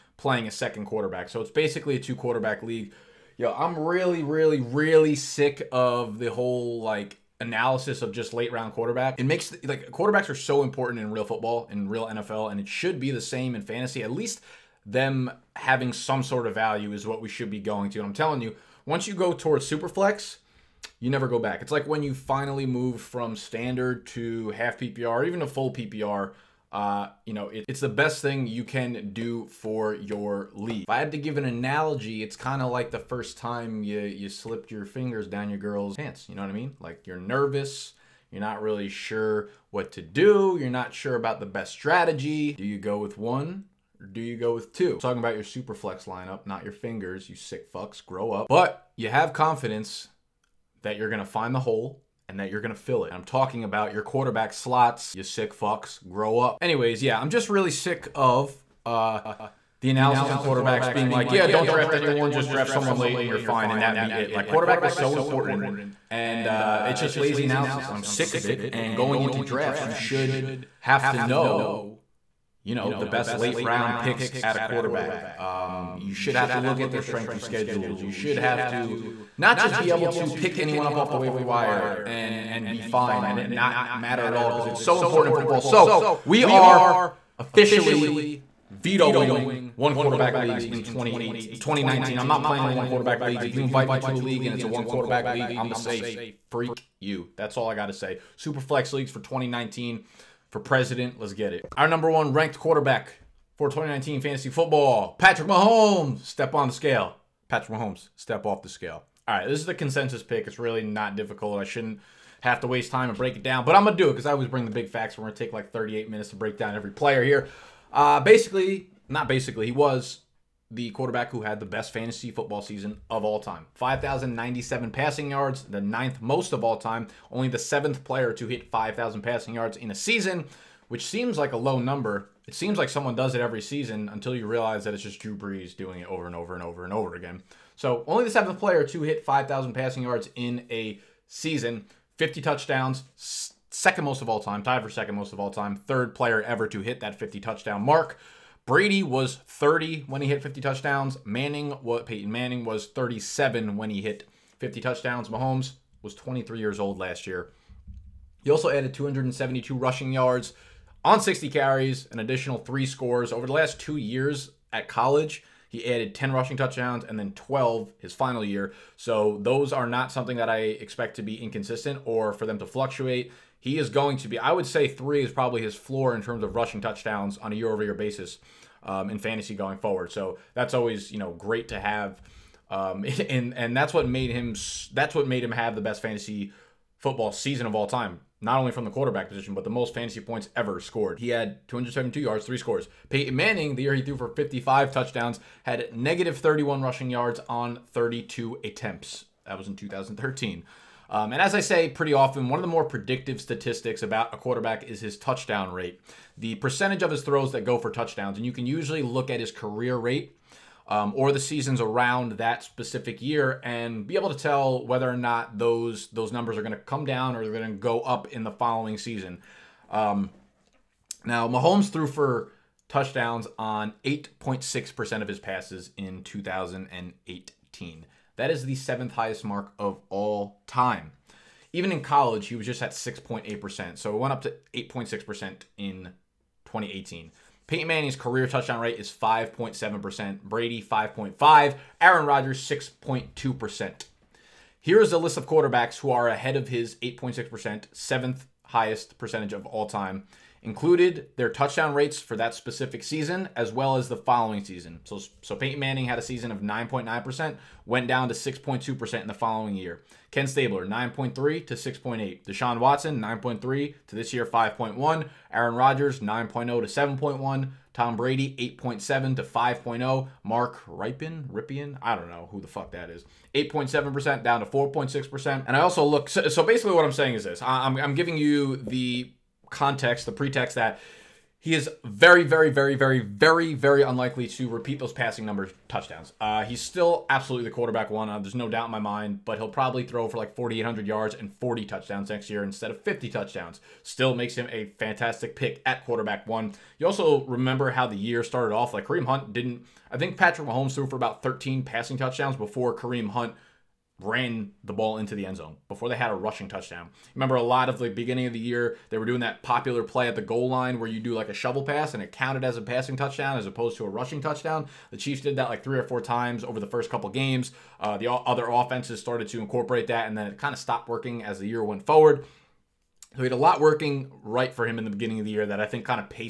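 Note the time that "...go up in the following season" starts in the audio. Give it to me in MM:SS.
03:37.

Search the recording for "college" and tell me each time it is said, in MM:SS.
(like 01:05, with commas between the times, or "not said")
02:44, 03:52.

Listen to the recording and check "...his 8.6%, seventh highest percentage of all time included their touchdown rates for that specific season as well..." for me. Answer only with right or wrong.
right.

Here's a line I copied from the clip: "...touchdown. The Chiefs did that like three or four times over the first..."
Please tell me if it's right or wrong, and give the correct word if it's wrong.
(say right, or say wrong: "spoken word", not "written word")
right.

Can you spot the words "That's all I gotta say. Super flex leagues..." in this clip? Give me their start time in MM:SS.
01:37.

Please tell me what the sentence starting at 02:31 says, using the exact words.
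Manning, what Peyton Manning was 37 when he hit 50 touchdowns.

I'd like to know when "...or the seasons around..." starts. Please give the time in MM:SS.
03:31.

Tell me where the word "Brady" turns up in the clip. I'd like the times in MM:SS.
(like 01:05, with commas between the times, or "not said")
02:28, 04:00, 04:28.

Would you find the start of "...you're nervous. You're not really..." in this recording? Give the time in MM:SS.
00:37.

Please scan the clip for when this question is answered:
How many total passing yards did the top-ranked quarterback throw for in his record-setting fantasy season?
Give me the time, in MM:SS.
02:03.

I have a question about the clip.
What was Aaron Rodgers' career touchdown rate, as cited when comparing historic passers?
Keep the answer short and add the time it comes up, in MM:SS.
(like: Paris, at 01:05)
6.2%, at 04:02.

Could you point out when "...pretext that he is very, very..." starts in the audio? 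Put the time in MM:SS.
04:40.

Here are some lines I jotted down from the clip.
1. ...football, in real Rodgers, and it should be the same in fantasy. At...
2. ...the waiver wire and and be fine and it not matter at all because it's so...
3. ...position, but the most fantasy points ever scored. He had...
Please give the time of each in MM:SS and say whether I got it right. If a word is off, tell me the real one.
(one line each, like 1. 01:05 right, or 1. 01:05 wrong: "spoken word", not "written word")
1. 00:11 wrong: "NFL", not "Rodgers"
2. 01:21 right
3. 03:09 right.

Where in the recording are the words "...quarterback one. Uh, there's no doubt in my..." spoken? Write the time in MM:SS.
04:47.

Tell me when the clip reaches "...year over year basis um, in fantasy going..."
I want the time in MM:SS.
02:57.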